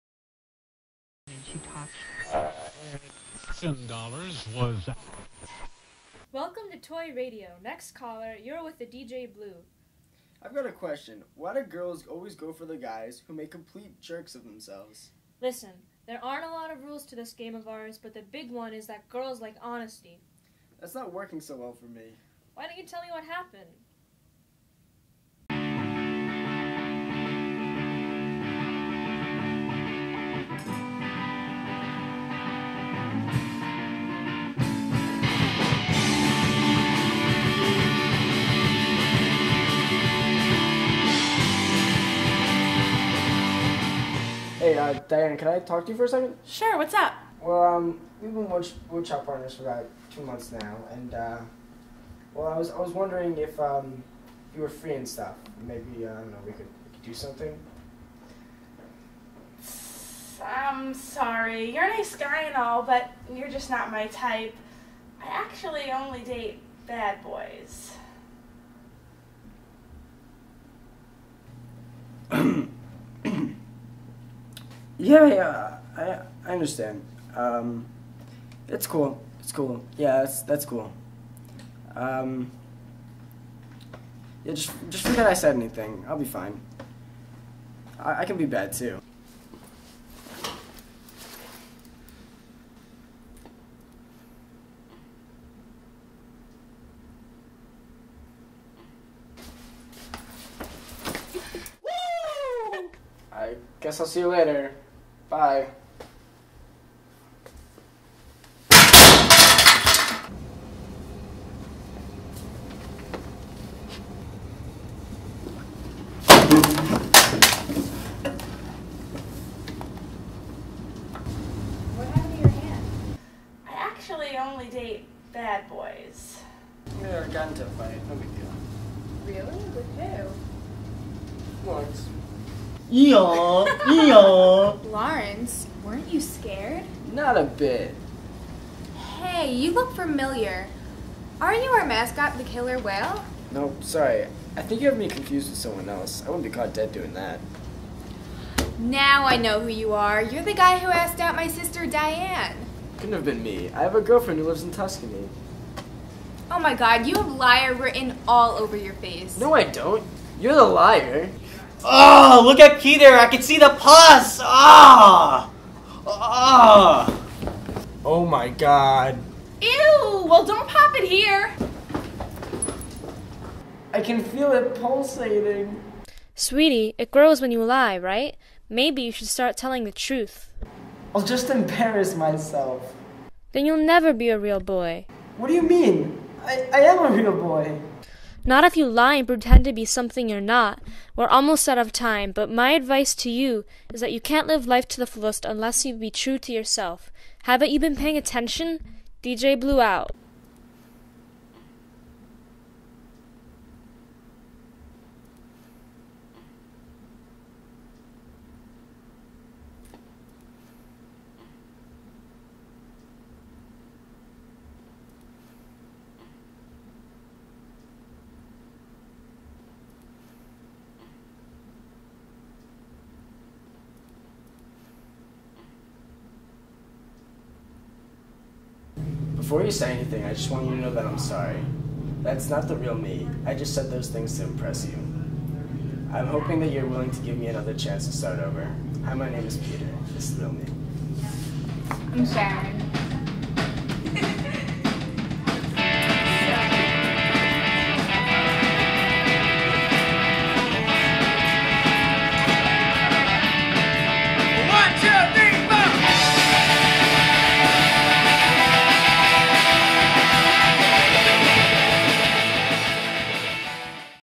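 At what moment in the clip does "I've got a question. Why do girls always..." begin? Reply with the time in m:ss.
0:10.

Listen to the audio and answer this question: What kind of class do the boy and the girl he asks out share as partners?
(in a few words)
Woodshop.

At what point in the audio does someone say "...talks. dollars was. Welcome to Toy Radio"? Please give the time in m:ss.
0:01.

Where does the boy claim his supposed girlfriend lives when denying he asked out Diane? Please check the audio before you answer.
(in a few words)
Tuscany.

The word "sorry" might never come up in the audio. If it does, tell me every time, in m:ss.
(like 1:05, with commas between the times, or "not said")
1:00, 2:23, 3:51.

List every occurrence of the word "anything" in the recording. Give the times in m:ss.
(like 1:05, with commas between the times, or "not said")
1:25, 3:49.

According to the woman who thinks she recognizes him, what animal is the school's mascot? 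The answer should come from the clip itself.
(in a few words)
Killer whale.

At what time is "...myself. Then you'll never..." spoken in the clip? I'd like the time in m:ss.
3:02.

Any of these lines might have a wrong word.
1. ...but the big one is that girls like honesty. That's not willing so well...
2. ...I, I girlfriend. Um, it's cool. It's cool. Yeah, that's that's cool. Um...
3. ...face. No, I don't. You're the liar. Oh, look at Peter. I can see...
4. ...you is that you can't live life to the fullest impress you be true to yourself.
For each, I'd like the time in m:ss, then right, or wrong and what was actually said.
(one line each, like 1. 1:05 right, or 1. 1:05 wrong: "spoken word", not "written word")
1. 0:18 wrong: "working", not "willing"
2. 1:15 wrong: "understand", not "girlfriend"
3. 2:38 right
4. 3:13 wrong: "unless", not "impress".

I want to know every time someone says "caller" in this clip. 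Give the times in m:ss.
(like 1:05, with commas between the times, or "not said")
0:07.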